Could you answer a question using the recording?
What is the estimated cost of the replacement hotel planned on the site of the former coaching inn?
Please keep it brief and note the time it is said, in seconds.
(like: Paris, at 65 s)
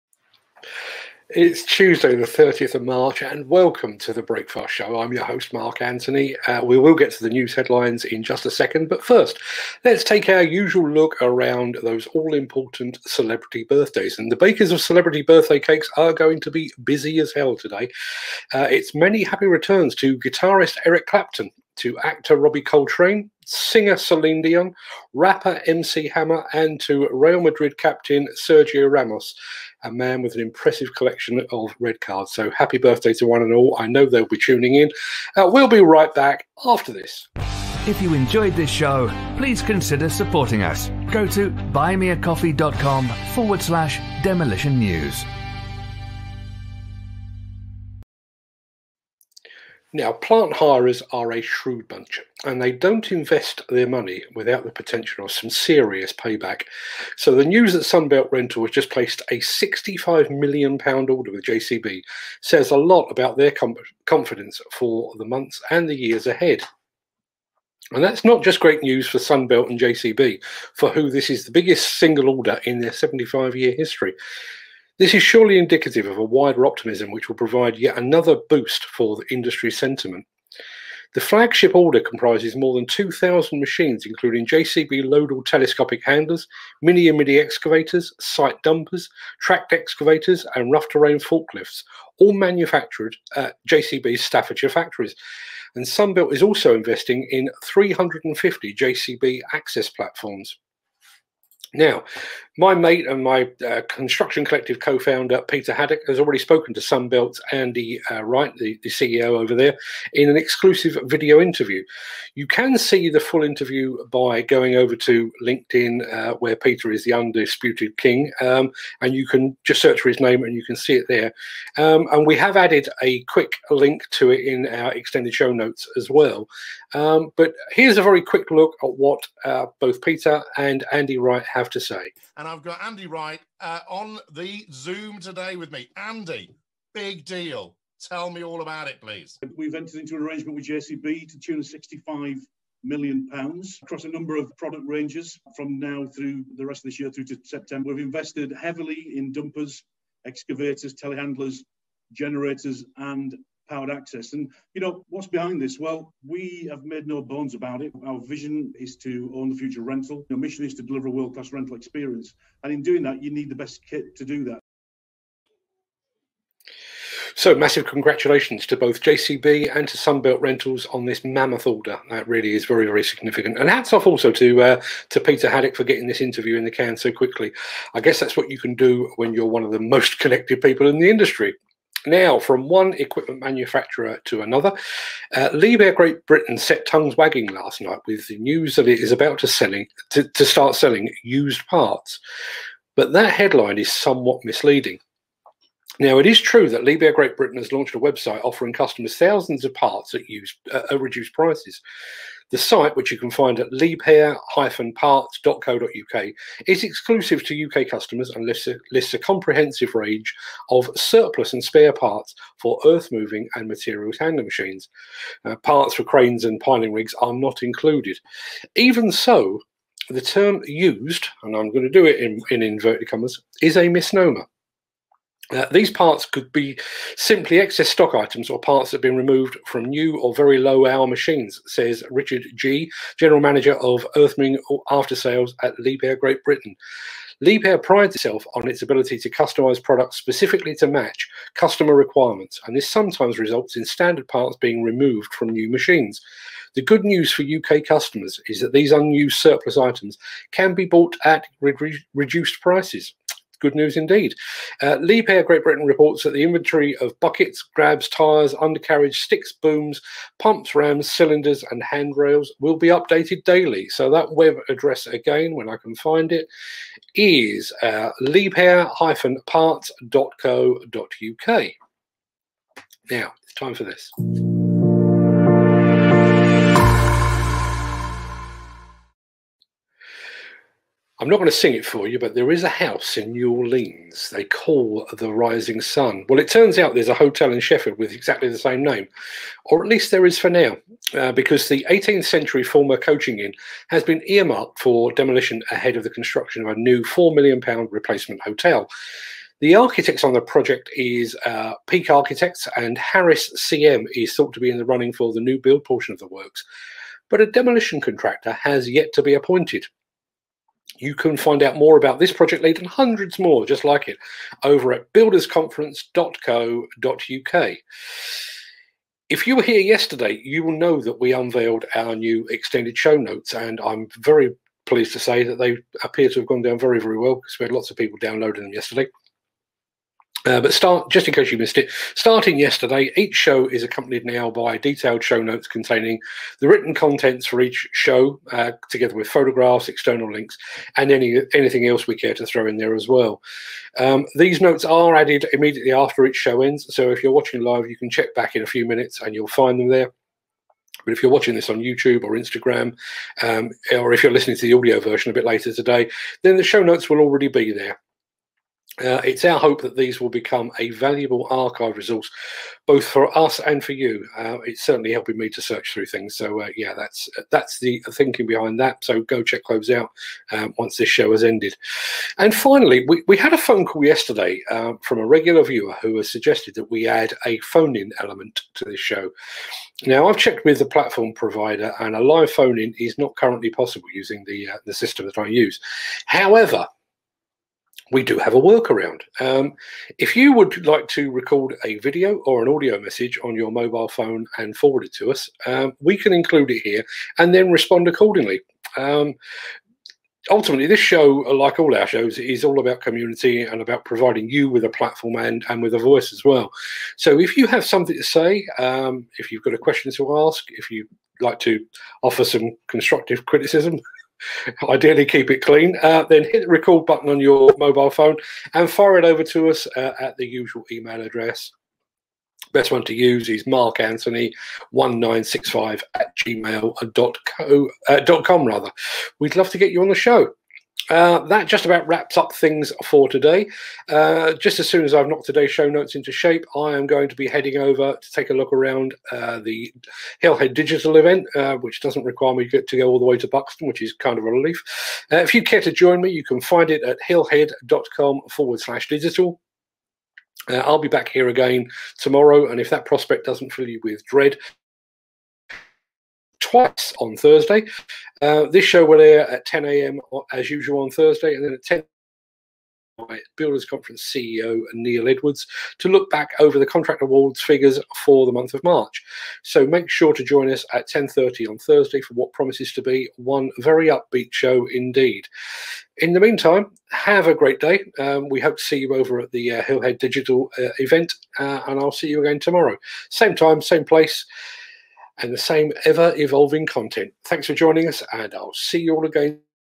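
£4 million, at 297 s.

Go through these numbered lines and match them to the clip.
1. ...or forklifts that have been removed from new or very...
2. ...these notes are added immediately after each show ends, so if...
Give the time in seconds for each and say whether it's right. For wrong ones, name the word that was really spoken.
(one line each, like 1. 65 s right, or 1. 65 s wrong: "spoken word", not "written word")
1. 228 s wrong: "parts", not "forklifts"
2. 344 s right.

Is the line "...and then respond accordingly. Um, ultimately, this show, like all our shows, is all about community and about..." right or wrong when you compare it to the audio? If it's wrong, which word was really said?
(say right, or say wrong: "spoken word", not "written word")
right.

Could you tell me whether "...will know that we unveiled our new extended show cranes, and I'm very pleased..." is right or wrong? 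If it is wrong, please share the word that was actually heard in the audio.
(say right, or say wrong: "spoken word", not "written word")
wrong: "notes", not "cranes".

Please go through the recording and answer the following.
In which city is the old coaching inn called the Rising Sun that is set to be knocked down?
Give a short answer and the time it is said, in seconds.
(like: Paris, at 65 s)
Sheffield, at 287 s.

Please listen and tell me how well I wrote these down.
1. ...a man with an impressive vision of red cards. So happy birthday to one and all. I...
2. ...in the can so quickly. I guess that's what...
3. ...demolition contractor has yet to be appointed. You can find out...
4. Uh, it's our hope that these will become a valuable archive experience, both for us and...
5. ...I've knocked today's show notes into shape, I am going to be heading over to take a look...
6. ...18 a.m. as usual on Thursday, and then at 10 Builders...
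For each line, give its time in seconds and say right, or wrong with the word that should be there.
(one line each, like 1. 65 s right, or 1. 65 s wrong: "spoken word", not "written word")
1. 29 s wrong: "collection", not "vision"
2. 176 s right
3. 307 s right
4. 358 s wrong: "resource", not "experience"
5. 435 s right
6. 459 s wrong: "10", not "18".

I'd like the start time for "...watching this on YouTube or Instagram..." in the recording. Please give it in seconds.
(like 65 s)
351 s.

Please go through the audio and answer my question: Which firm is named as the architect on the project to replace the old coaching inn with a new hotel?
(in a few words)
Peak Architects.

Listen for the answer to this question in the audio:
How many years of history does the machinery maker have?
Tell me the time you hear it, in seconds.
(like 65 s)
72 s.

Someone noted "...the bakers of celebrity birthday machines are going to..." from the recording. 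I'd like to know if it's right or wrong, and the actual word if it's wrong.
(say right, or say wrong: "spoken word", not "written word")
wrong: "cakes", not "machines".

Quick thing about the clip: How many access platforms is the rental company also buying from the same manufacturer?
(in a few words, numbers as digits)
350.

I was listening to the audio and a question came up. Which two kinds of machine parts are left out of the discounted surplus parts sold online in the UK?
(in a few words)
cranes and piling rigs.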